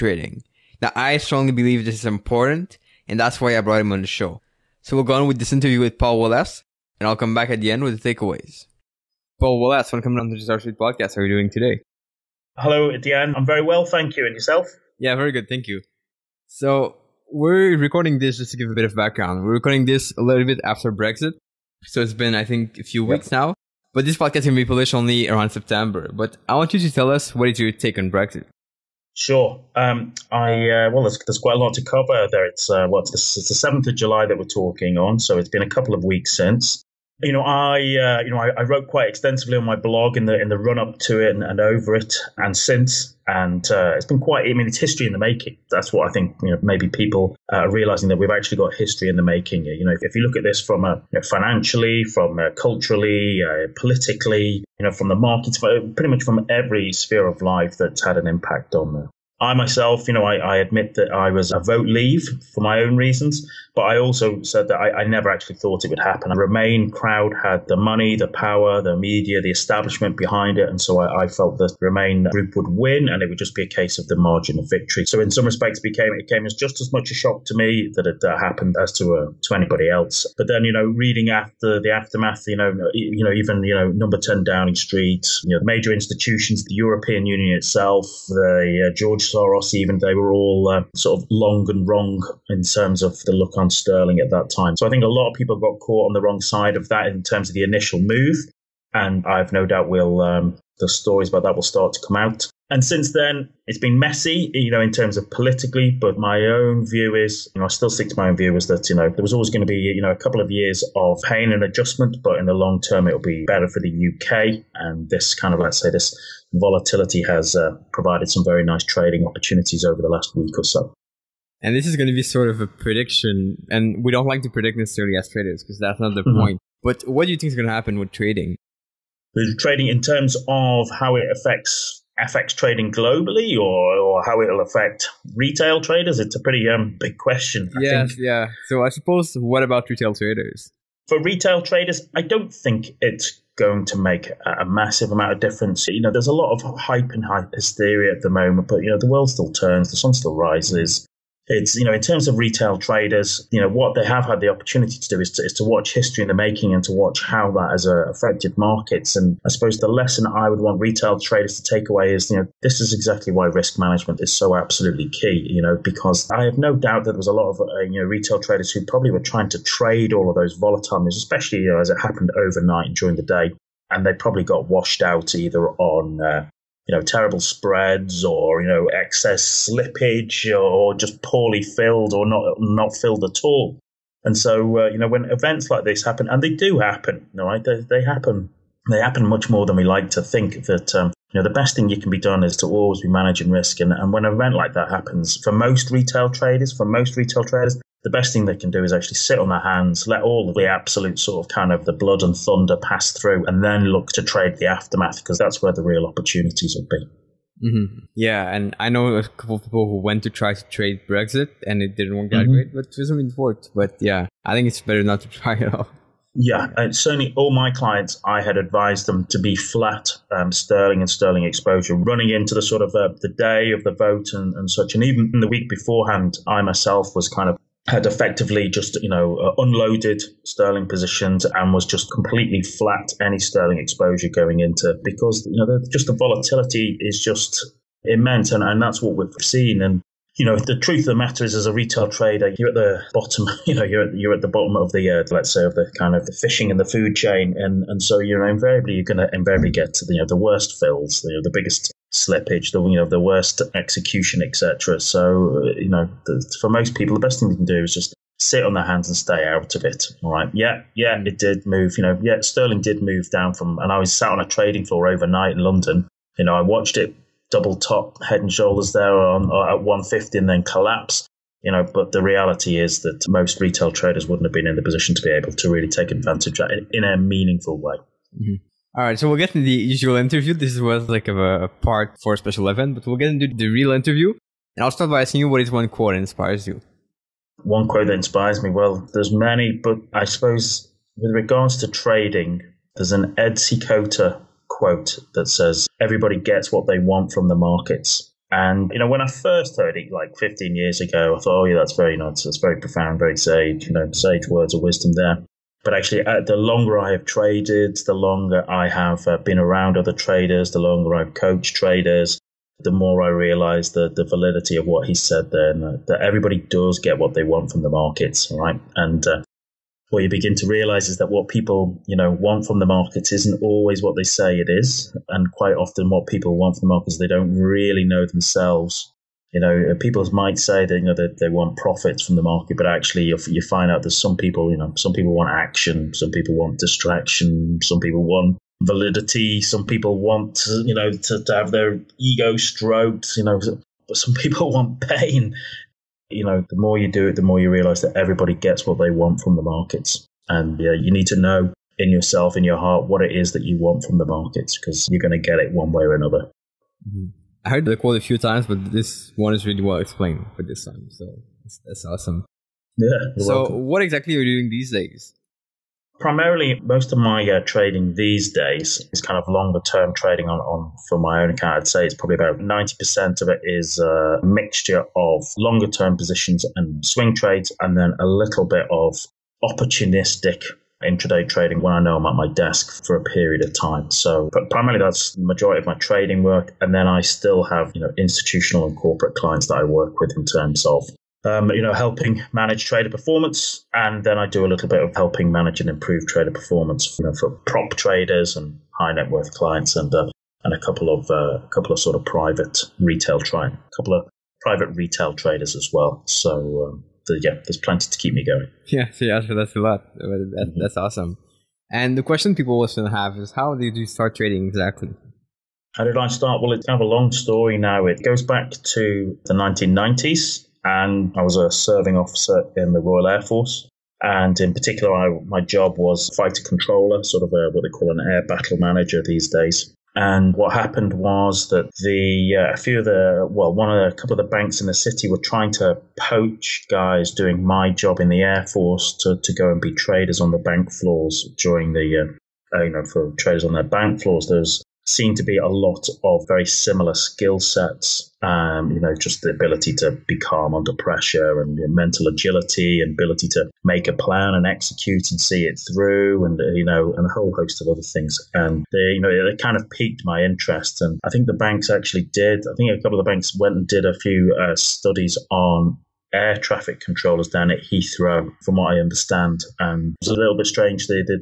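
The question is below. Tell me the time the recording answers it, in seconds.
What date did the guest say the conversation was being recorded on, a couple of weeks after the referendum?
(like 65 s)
33 s.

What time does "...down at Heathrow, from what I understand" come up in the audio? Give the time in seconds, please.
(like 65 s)
467 s.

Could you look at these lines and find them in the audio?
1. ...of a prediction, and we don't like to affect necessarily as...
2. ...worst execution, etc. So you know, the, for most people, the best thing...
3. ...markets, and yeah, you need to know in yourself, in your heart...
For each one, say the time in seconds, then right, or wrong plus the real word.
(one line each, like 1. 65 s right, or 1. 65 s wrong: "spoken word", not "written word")
1. 122 s wrong: "predict", not "affect"
2. 253 s right
3. 349 s right.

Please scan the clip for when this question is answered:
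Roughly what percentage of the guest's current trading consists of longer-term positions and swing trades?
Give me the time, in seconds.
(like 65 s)
372 s.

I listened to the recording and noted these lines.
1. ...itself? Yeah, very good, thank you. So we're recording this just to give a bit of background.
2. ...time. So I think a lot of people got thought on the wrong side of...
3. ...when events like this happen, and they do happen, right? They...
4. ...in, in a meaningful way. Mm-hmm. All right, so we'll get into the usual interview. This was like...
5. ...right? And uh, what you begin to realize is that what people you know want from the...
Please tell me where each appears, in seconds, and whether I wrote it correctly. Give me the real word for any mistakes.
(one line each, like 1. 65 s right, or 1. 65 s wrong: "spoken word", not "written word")
1. 14 s wrong: "yourself", not "itself"
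2. 94 s wrong: "caught", not "thought"
3. 185 s right
4. 276 s right
5. 318 s right.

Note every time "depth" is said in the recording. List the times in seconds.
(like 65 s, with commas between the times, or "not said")
not said.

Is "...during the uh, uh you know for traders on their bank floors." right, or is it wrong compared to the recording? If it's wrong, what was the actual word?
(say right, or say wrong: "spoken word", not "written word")
right.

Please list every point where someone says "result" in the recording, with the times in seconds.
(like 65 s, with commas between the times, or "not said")
not said.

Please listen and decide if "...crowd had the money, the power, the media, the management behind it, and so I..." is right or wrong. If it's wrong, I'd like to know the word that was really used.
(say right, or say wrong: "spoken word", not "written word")
wrong: "establishment", not "management".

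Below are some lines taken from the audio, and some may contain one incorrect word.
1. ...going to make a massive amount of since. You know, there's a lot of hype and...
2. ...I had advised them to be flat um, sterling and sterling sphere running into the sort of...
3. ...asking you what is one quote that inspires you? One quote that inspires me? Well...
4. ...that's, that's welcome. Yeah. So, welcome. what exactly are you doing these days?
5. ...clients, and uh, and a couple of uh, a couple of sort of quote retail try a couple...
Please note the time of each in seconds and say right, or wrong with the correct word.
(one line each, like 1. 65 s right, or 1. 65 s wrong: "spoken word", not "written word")
1. 143 s wrong: "difference", not "since"
2. 218 s wrong: "exposure", not "sphere"
3. 285 s right
4. 361 s wrong: "awesome", not "welcome"
5. 399 s wrong: "private", not "quote".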